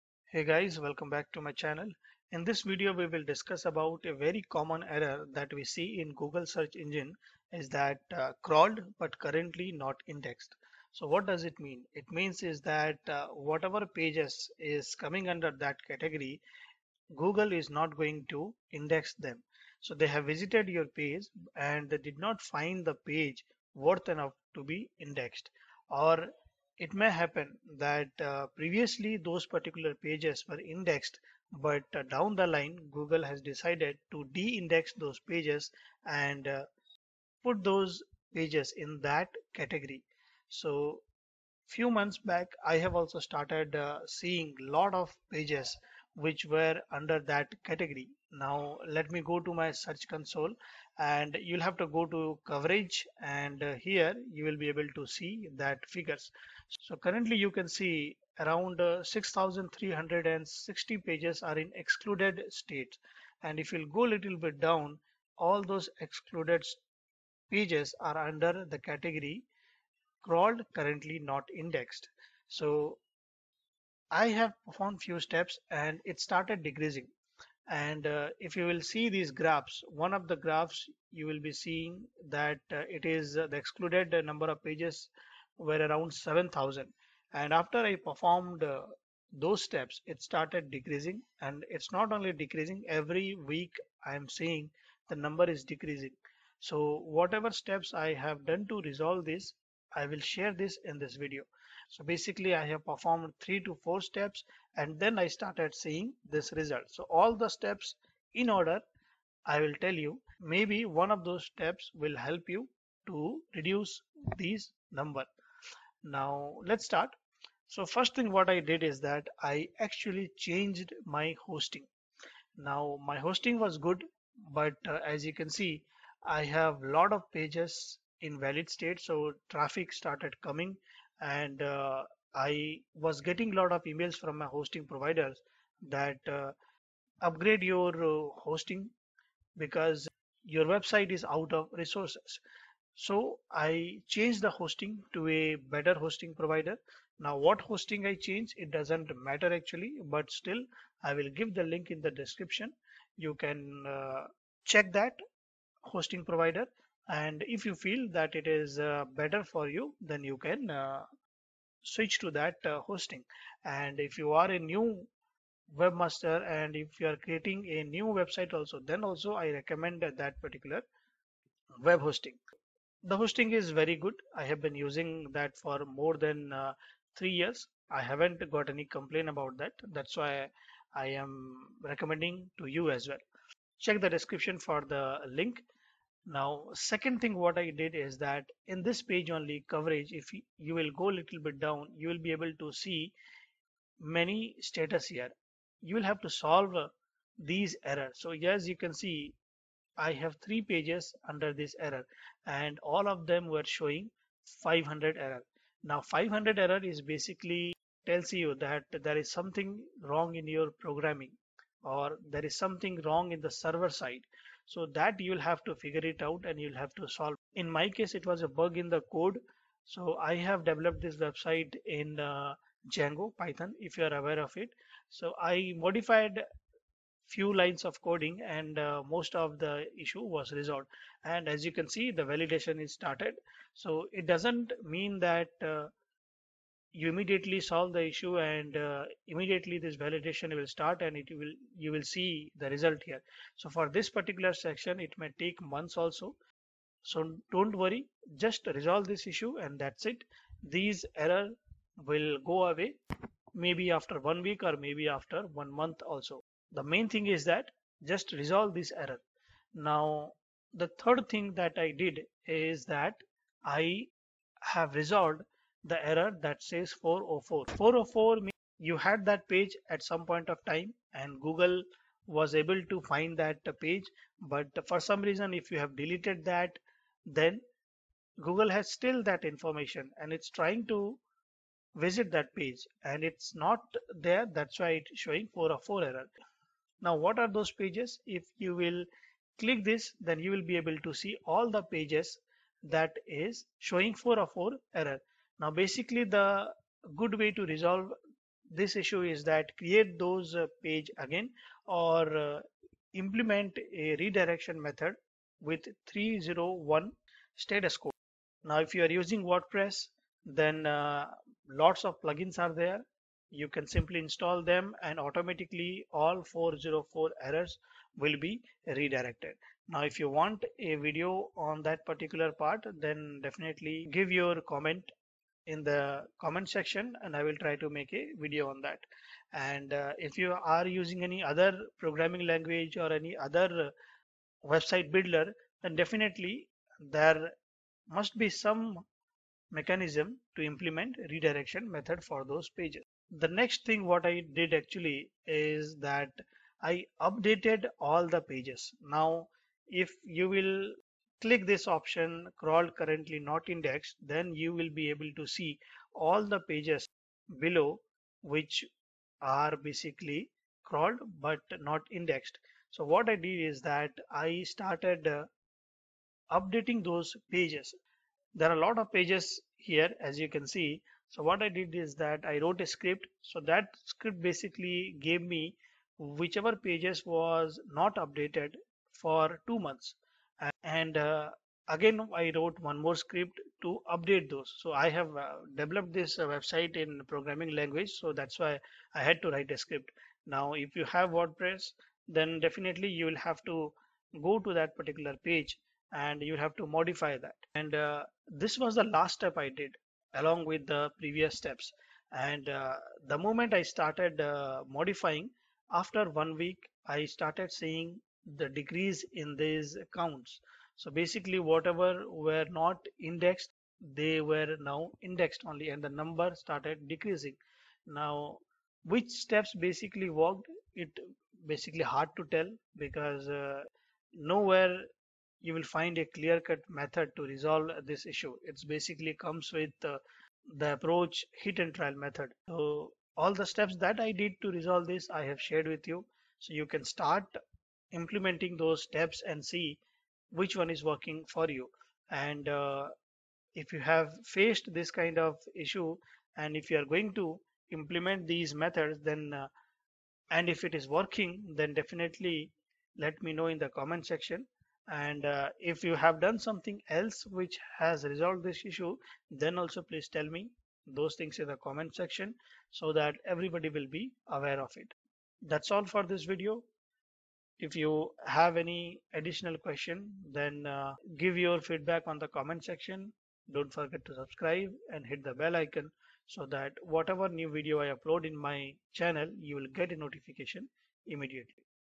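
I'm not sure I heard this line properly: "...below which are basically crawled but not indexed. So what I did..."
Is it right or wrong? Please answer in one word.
right.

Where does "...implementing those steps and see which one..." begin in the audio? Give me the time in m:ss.
7:18.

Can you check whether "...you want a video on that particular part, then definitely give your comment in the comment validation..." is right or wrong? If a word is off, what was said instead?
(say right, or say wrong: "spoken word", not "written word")
wrong: "section", not "validation".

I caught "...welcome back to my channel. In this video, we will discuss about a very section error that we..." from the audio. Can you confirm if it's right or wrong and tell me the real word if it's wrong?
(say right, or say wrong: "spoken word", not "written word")
wrong: "common", not "section".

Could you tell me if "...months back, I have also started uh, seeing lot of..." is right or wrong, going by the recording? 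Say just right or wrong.
right.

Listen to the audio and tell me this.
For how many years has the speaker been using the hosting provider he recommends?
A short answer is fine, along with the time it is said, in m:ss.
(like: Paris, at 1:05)
3, at 2:57.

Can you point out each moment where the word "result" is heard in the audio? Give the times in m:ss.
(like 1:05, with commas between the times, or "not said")
1:46, 4:02.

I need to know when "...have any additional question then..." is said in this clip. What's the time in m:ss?
7:48.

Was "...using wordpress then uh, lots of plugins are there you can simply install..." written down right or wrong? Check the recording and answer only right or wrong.
right.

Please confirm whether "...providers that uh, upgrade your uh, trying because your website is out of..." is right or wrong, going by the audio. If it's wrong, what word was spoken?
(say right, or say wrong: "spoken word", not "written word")
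wrong: "hosting", not "trying".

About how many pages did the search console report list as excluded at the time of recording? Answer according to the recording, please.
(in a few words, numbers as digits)
6360.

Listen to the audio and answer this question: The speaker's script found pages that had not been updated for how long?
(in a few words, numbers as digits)
2 months.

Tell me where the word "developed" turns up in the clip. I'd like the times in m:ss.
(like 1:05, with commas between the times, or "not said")
3:40, 6:25.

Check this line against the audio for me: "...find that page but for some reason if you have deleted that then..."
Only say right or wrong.
right.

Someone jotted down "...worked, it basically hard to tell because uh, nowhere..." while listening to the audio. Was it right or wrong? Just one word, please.
right.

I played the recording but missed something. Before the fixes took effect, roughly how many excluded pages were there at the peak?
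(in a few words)
7000.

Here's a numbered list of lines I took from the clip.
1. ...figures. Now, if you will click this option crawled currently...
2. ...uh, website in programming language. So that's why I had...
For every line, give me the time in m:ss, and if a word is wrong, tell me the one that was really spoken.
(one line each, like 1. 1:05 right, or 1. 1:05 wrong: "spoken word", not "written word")
1. 5:48 wrong: "pages", not "figures"
2. 6:26 right.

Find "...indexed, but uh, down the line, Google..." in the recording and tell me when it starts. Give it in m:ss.
0:30.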